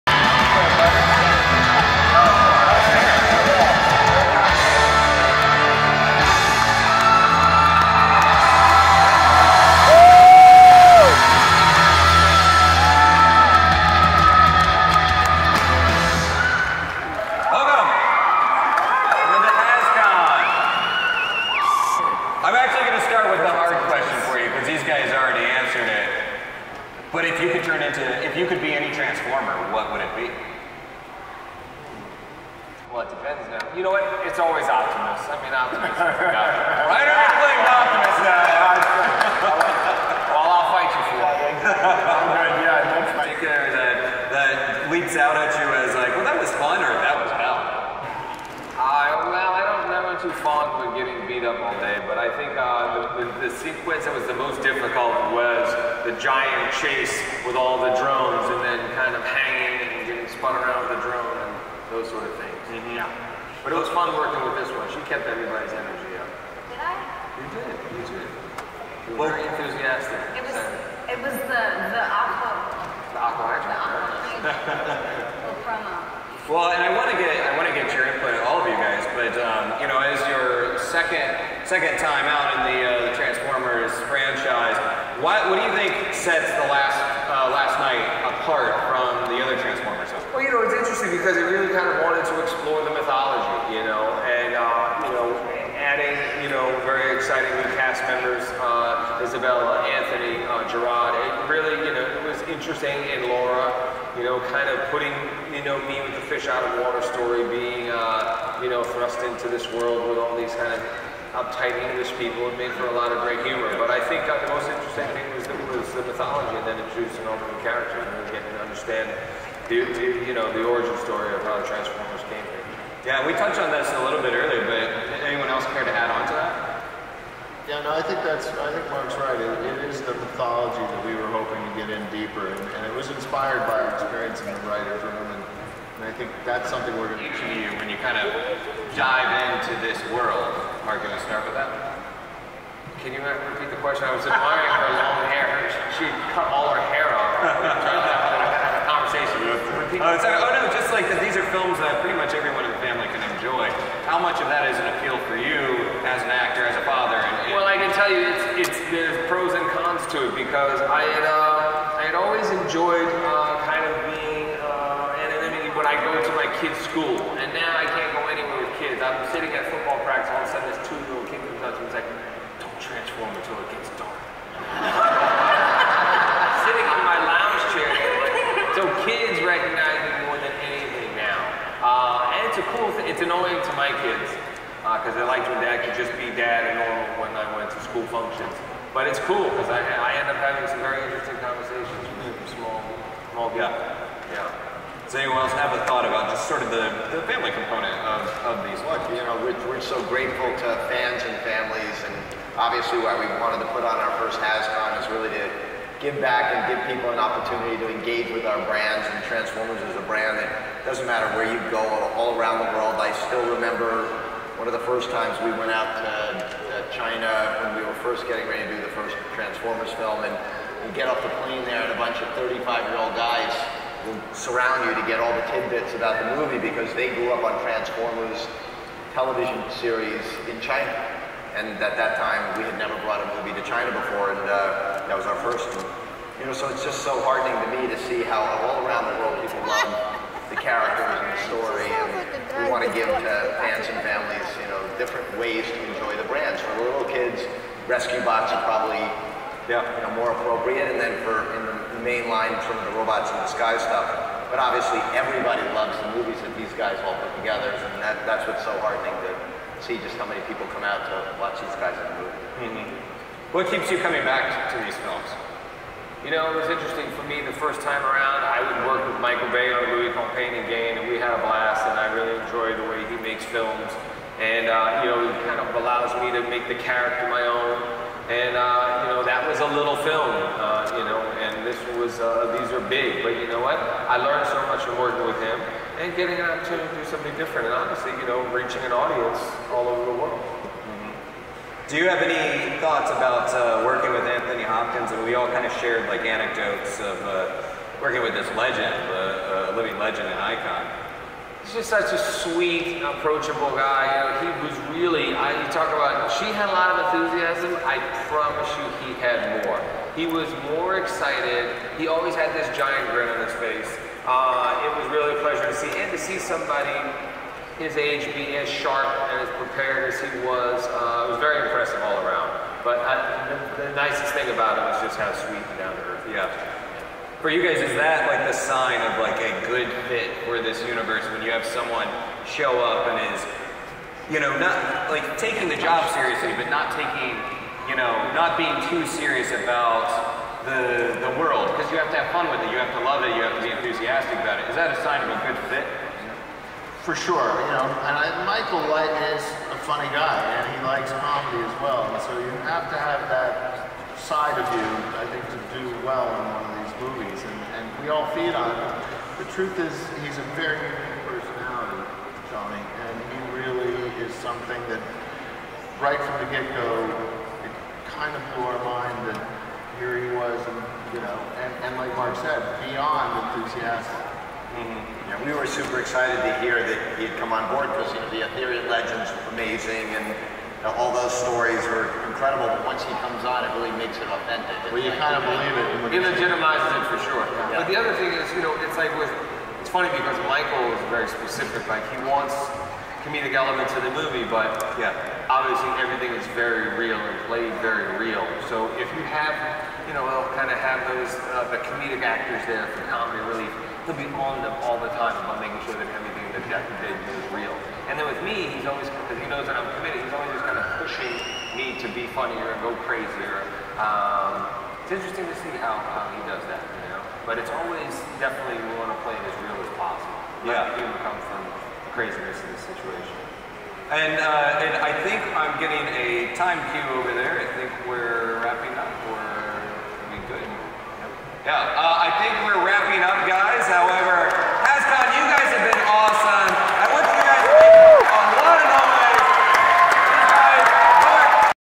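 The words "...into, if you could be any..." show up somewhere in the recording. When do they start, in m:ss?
0:27.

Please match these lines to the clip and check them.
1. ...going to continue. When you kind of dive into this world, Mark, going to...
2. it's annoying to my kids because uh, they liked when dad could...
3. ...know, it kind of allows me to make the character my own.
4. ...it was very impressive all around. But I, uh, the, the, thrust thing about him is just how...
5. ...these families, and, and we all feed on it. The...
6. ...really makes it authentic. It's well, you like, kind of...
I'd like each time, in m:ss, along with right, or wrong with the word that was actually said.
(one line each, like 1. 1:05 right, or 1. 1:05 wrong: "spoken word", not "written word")
1. 2:17 right
2. 3:03 right
3. 4:35 right
4. 5:21 wrong: "nicest", not "thrust"
5. 5:56 wrong: "movies", not "families"
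6. 6:23 right.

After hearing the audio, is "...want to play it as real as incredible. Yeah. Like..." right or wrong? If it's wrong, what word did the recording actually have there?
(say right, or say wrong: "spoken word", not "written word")
wrong: "possible", not "incredible".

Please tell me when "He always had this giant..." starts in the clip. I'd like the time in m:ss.
5:12.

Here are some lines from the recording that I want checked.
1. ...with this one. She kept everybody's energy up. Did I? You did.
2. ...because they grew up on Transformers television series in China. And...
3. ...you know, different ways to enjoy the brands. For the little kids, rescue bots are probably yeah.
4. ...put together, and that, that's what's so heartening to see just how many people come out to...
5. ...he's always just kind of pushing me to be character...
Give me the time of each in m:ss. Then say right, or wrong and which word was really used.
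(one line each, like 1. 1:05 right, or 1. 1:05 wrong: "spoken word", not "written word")
1. 1:04 right
2. 3:46 right
3. 4:04 right
4. 4:17 right
5. 6:50 wrong: "funnier", not "character".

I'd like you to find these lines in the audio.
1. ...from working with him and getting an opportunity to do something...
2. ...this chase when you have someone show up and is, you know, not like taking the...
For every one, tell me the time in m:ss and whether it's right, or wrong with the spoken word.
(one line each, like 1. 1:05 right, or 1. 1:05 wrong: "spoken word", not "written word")
1. 4:44 right
2. 5:30 wrong: "universe", not "chase".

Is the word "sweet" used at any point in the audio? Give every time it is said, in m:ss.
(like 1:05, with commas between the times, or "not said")
5:02, 5:25.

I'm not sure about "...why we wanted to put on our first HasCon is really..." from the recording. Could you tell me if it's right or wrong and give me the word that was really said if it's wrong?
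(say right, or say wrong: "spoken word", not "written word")
right.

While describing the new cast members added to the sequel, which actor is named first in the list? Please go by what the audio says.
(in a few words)
Isabela.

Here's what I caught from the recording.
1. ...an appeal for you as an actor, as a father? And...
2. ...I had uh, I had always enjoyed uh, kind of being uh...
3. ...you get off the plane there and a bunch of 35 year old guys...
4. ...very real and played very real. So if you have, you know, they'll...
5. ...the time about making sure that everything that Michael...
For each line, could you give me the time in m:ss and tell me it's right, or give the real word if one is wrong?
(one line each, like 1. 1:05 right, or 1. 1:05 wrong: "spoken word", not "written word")
1. 2:34 right
2. 2:40 right
3. 3:40 right
4. 6:36 right
5. 6:44 wrong: "Jack", not "Michael".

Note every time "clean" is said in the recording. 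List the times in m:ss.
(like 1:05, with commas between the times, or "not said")
not said.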